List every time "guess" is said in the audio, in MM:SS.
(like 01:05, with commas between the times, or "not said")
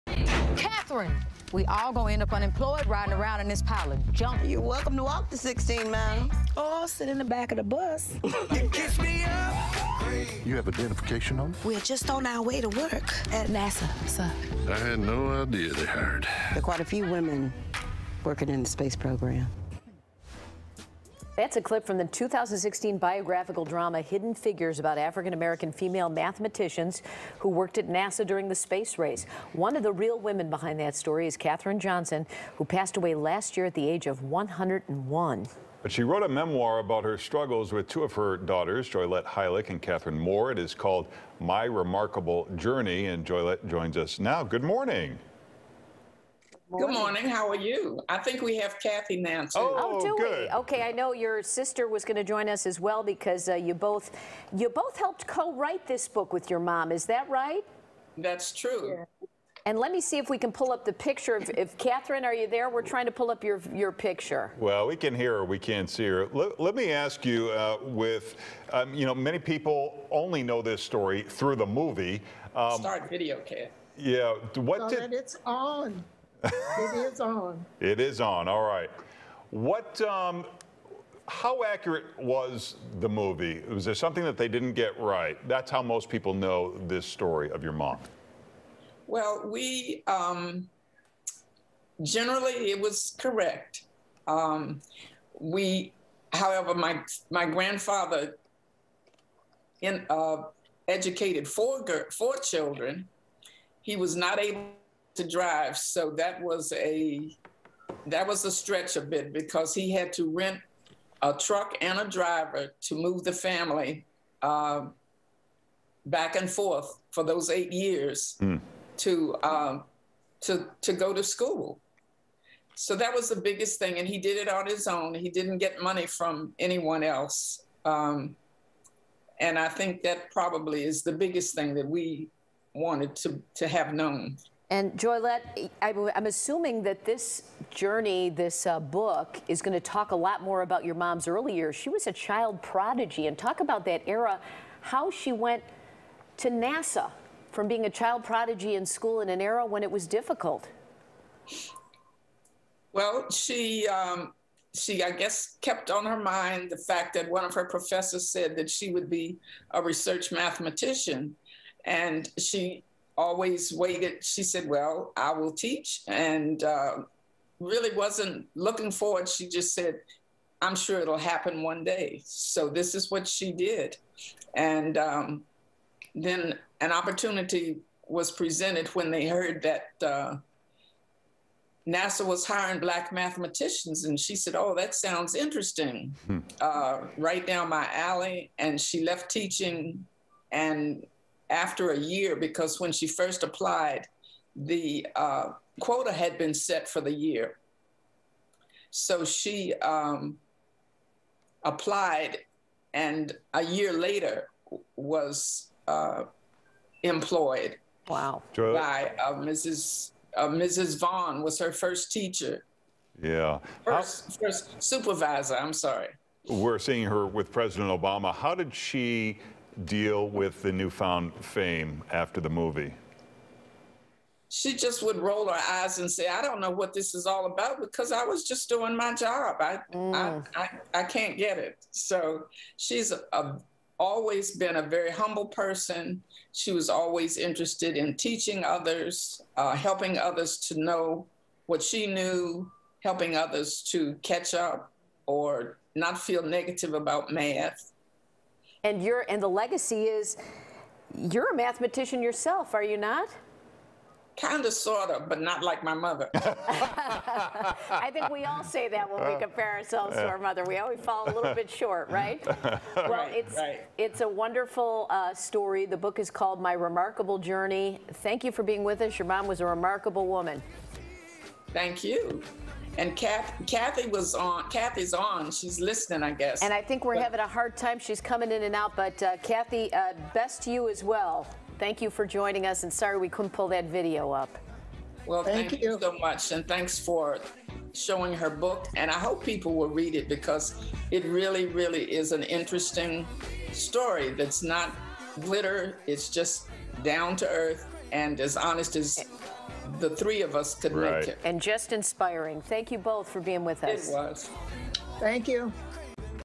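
02:35, 04:36.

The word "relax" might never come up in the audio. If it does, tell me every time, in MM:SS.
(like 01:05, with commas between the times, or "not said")
not said.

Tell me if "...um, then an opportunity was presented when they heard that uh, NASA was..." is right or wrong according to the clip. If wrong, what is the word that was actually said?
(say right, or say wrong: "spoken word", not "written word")
right.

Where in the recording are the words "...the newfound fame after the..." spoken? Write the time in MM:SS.
03:40.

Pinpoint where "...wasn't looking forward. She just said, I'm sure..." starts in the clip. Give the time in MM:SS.
02:47.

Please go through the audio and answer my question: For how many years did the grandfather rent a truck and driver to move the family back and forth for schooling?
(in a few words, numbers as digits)
8.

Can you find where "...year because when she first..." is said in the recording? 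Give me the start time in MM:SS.
03:11.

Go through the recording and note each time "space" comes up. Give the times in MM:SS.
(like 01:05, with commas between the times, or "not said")
00:18, 00:28.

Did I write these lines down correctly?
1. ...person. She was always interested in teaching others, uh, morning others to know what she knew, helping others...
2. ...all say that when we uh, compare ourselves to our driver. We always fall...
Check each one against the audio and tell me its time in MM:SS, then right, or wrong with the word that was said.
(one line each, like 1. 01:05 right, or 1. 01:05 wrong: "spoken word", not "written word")
1. 03:55 wrong: "helping", not "morning"
2. 04:18 wrong: "mother", not "driver".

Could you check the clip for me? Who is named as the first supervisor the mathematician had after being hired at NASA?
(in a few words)
Mrs. Vaughn.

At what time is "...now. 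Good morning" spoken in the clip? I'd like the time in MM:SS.
00:44.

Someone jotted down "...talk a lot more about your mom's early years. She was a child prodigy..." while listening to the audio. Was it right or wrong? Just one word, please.
right.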